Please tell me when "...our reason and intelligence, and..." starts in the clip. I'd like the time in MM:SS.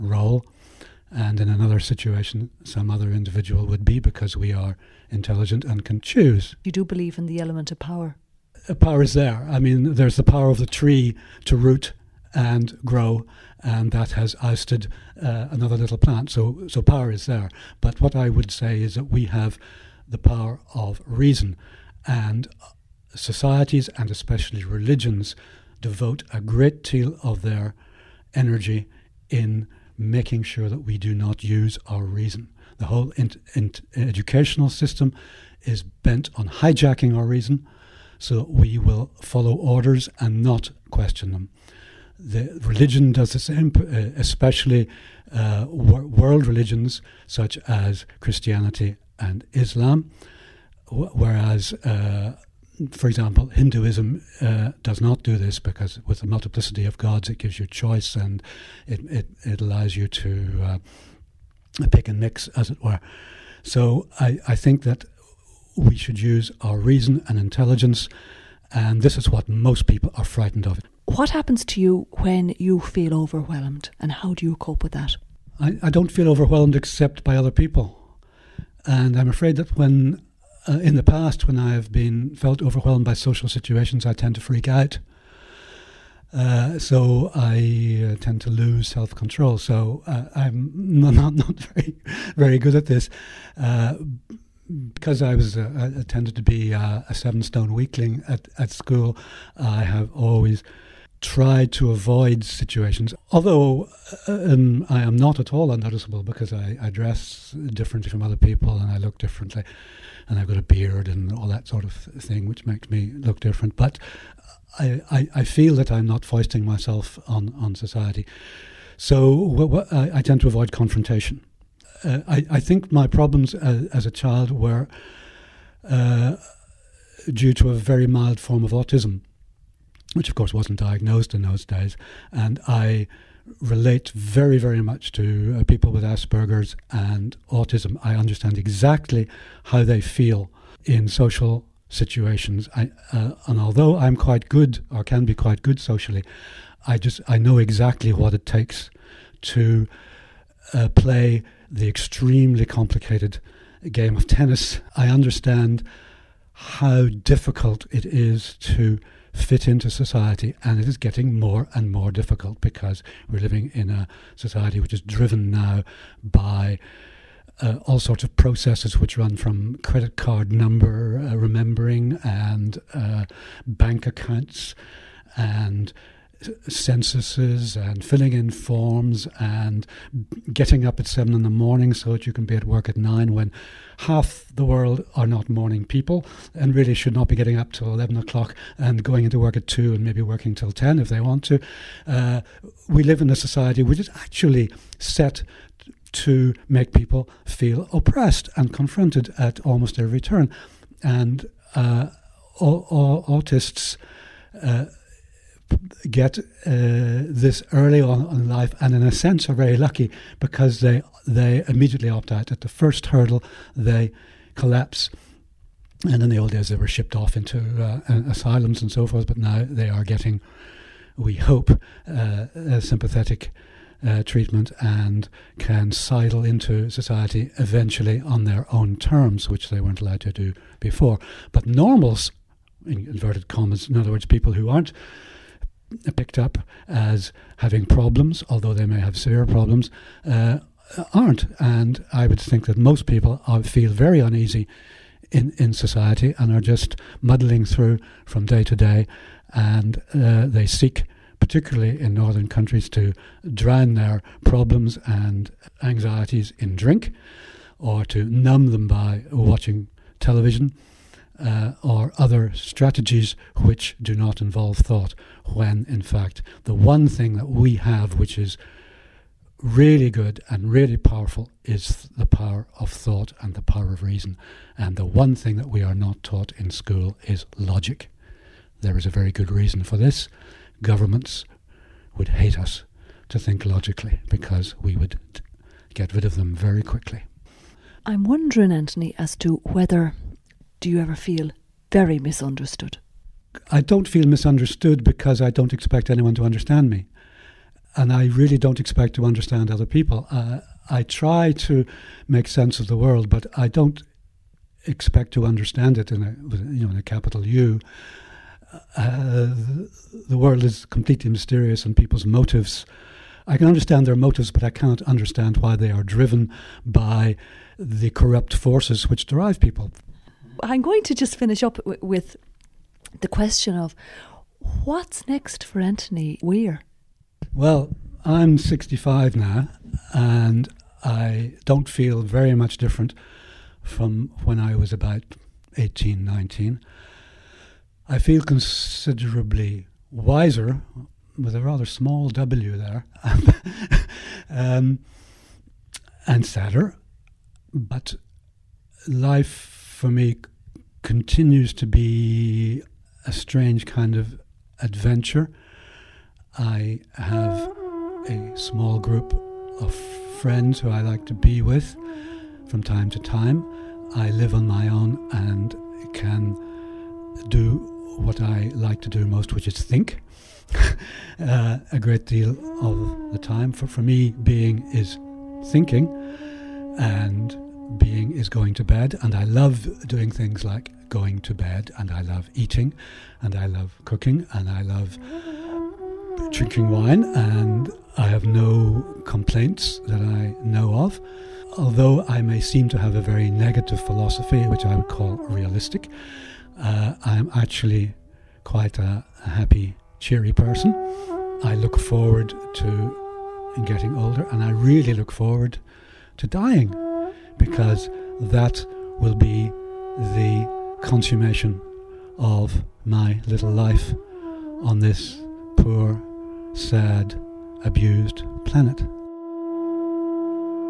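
01:06.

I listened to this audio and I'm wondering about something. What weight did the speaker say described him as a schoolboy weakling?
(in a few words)
7 stone.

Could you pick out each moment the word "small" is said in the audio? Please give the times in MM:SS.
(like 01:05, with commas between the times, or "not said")
05:41, 05:58.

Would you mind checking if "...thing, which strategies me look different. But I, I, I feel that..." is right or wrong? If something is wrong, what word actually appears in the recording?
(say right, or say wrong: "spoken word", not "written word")
wrong: "makes", not "strategies".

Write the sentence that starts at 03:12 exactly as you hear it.
Uh, we live in a society which is actually set to make people feel oppressed and confronted at almost every turn.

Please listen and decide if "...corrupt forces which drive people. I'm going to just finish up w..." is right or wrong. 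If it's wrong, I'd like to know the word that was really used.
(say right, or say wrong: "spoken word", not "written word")
right.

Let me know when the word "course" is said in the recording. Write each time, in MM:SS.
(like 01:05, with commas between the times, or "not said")
02:10.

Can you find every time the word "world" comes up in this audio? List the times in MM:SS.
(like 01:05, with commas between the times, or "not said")
00:45, 03:04, 05:02, 05:10.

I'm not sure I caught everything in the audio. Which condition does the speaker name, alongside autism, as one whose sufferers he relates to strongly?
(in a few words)
Asperger's.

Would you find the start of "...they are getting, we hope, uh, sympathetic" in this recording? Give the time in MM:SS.
03:39.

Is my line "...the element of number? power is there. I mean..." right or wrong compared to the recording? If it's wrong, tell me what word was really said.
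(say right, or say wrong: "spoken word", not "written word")
wrong: "power", not "number".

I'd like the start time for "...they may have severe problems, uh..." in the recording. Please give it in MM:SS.
03:58.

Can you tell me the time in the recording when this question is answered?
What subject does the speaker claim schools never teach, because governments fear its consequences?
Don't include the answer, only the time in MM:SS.
04:37.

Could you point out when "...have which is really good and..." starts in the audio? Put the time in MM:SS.
04:27.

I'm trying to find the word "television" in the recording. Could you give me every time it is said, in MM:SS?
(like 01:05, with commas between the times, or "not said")
04:20.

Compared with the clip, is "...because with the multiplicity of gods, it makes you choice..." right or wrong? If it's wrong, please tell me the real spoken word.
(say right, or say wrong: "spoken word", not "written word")
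wrong: "gives", not "makes".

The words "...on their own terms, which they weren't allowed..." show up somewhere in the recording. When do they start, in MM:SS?
03:48.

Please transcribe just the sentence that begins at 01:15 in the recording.
I, I don't feel overwhelmed except by other people.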